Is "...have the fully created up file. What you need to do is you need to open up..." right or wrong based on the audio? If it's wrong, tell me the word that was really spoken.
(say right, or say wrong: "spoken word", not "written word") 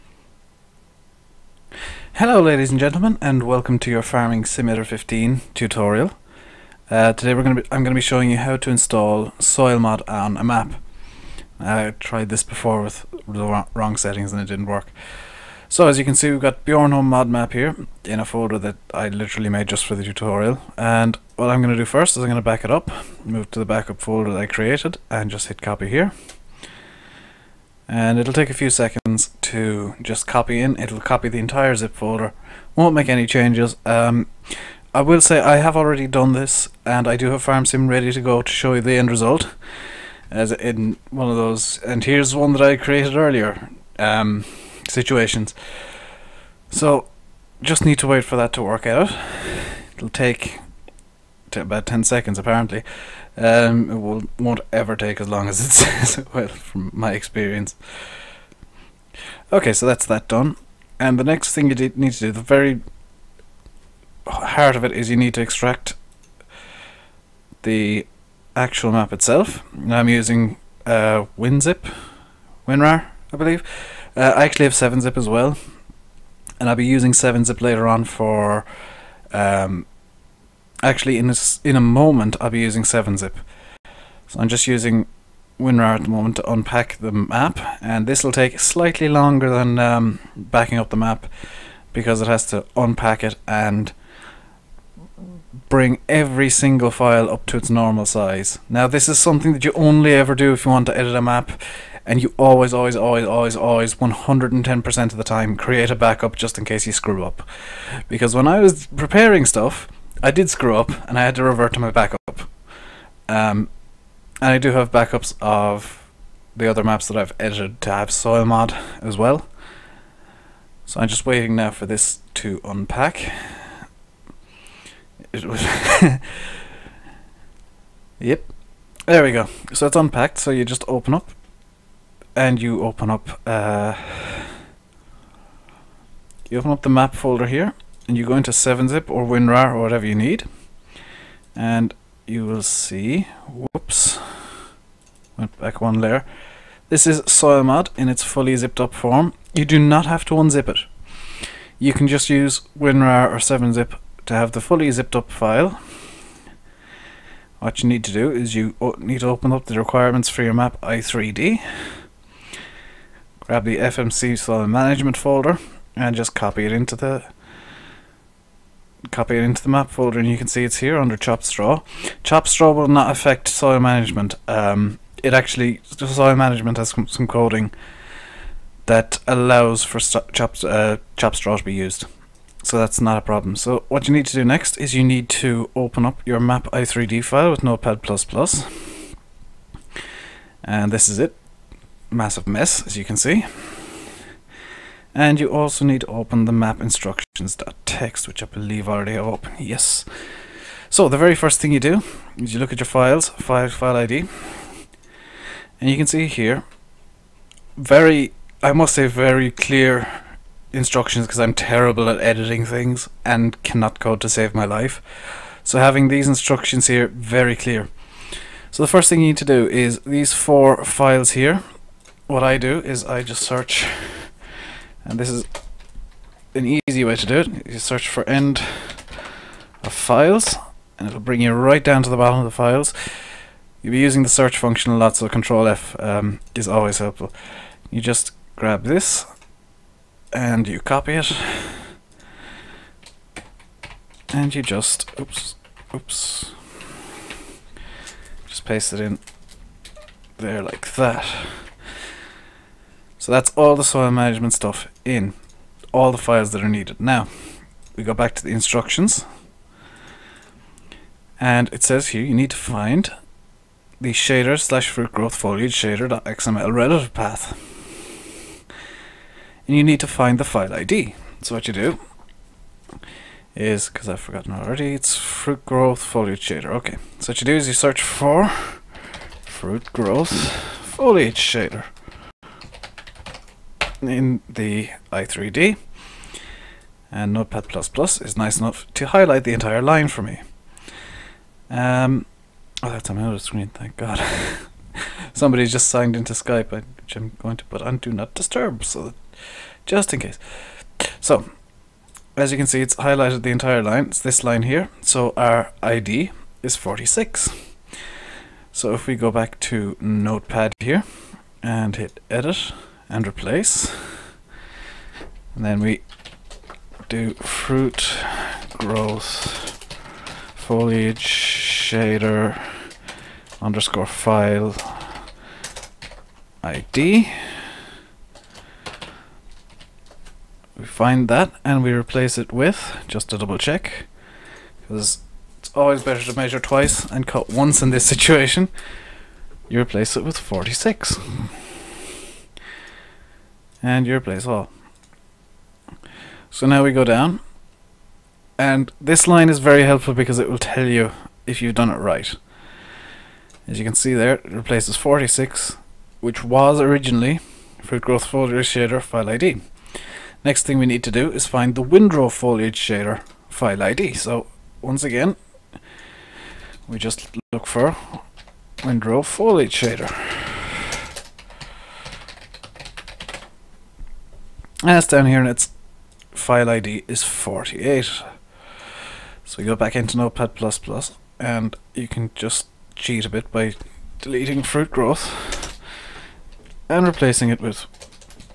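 wrong: "zipped", not "created".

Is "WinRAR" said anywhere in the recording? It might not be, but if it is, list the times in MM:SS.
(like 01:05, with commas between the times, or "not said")
01:12, 01:25, 02:19, 02:32.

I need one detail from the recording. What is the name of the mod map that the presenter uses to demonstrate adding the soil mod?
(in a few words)
Bjornholm.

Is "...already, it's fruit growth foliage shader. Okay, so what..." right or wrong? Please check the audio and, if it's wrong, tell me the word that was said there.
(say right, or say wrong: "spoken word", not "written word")
right.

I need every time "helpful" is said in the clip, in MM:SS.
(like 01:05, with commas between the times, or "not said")
03:56, 05:49.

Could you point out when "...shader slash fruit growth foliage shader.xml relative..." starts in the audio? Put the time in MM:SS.
04:24.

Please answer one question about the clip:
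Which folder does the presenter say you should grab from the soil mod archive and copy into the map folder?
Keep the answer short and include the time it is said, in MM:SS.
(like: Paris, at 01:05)
FMC soil management, at 02:43.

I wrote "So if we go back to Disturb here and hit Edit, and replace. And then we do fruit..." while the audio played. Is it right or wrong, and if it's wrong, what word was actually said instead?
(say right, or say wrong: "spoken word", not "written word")
wrong: "Notepad", not "Disturb".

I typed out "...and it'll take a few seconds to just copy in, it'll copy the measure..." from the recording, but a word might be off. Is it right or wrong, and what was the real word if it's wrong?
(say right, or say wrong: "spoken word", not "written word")
wrong: "entire", not "measure".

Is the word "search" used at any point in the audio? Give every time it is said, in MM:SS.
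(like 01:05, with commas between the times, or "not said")
03:43, 03:47, 03:54, 04:37.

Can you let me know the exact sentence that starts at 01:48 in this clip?
Because when I was preparing stuff, I did screw up and I had to revert to my backup.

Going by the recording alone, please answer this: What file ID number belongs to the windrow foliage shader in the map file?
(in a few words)
48.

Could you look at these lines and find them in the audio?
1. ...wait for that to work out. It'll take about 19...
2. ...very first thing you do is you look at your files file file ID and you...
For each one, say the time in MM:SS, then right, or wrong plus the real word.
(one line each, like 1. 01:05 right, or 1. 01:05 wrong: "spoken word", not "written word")
1. 00:48 wrong: "10", not "19"
2. 03:21 right.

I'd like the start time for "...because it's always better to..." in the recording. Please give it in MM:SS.
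05:34.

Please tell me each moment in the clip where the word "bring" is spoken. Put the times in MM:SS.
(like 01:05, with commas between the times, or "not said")
01:35, 03:51.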